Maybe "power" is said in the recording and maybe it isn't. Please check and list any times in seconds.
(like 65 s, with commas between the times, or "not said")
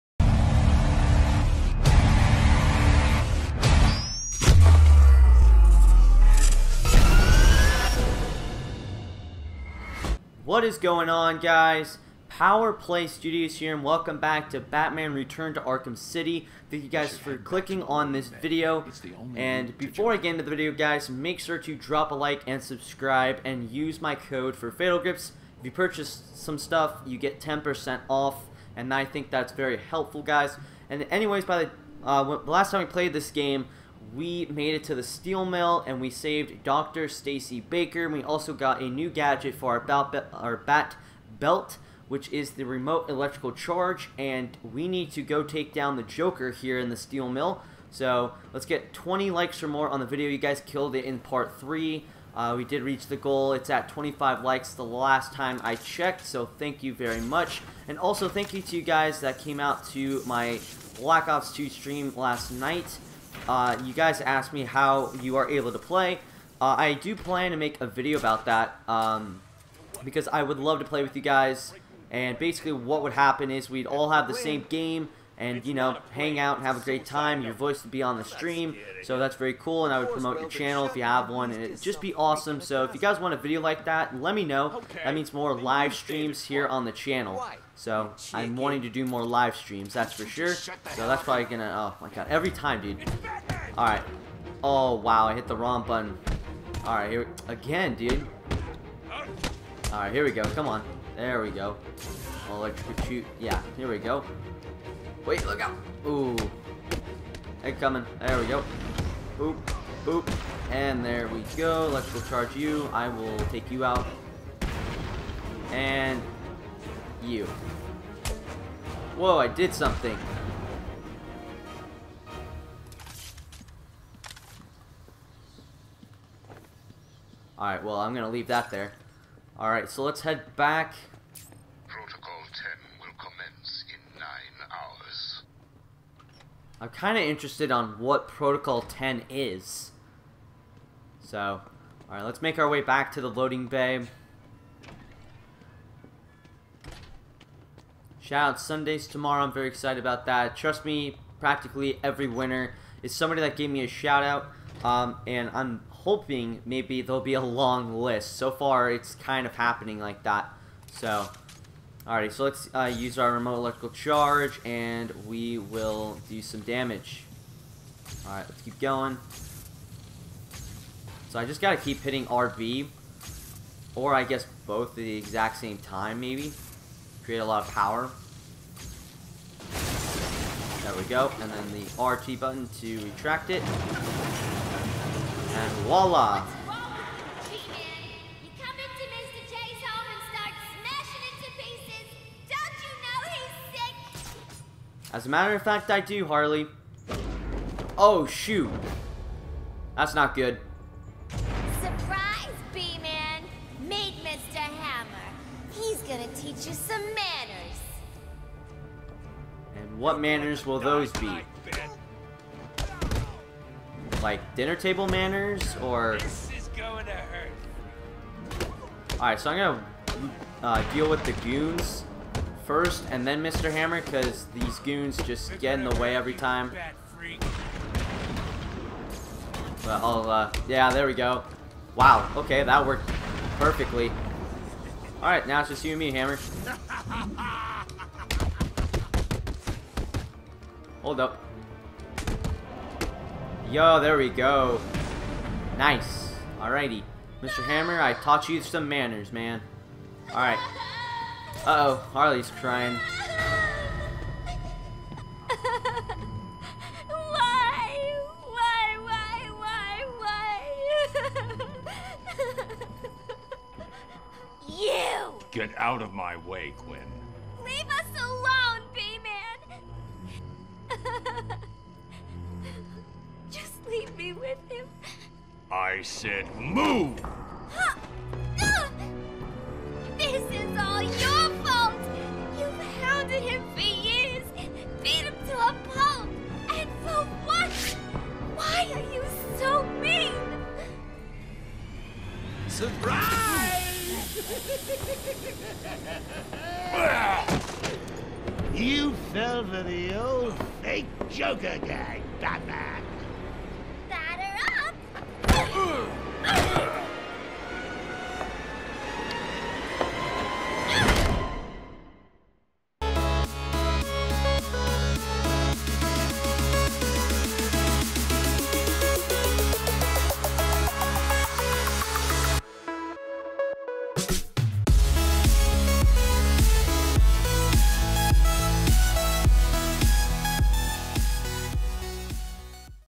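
12 s, 177 s.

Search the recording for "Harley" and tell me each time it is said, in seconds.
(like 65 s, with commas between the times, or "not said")
196 s, 252 s.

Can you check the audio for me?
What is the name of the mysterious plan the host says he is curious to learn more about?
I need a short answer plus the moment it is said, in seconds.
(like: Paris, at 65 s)
Protocol 10, at 138 s.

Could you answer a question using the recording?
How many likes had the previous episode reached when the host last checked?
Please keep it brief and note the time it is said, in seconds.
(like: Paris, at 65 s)
25, at 53 s.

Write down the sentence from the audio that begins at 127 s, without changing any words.
Alright, well, I'm going to leave that there.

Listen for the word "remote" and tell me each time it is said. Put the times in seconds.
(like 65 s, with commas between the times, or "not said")
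42 s, 163 s.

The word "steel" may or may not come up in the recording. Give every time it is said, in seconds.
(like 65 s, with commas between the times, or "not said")
35 s, 46 s.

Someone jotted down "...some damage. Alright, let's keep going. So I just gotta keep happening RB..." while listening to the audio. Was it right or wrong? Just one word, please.
wrong.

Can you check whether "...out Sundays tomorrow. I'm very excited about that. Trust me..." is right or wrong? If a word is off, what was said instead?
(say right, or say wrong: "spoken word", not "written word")
right.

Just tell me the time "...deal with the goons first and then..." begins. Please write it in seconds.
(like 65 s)
220 s.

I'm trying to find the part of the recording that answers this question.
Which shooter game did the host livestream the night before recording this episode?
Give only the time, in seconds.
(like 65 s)
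60 s.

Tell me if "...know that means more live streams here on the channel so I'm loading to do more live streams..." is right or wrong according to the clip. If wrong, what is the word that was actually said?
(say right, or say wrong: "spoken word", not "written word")
wrong: "wanting", not "loading".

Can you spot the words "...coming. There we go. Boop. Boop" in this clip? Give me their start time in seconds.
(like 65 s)
107 s.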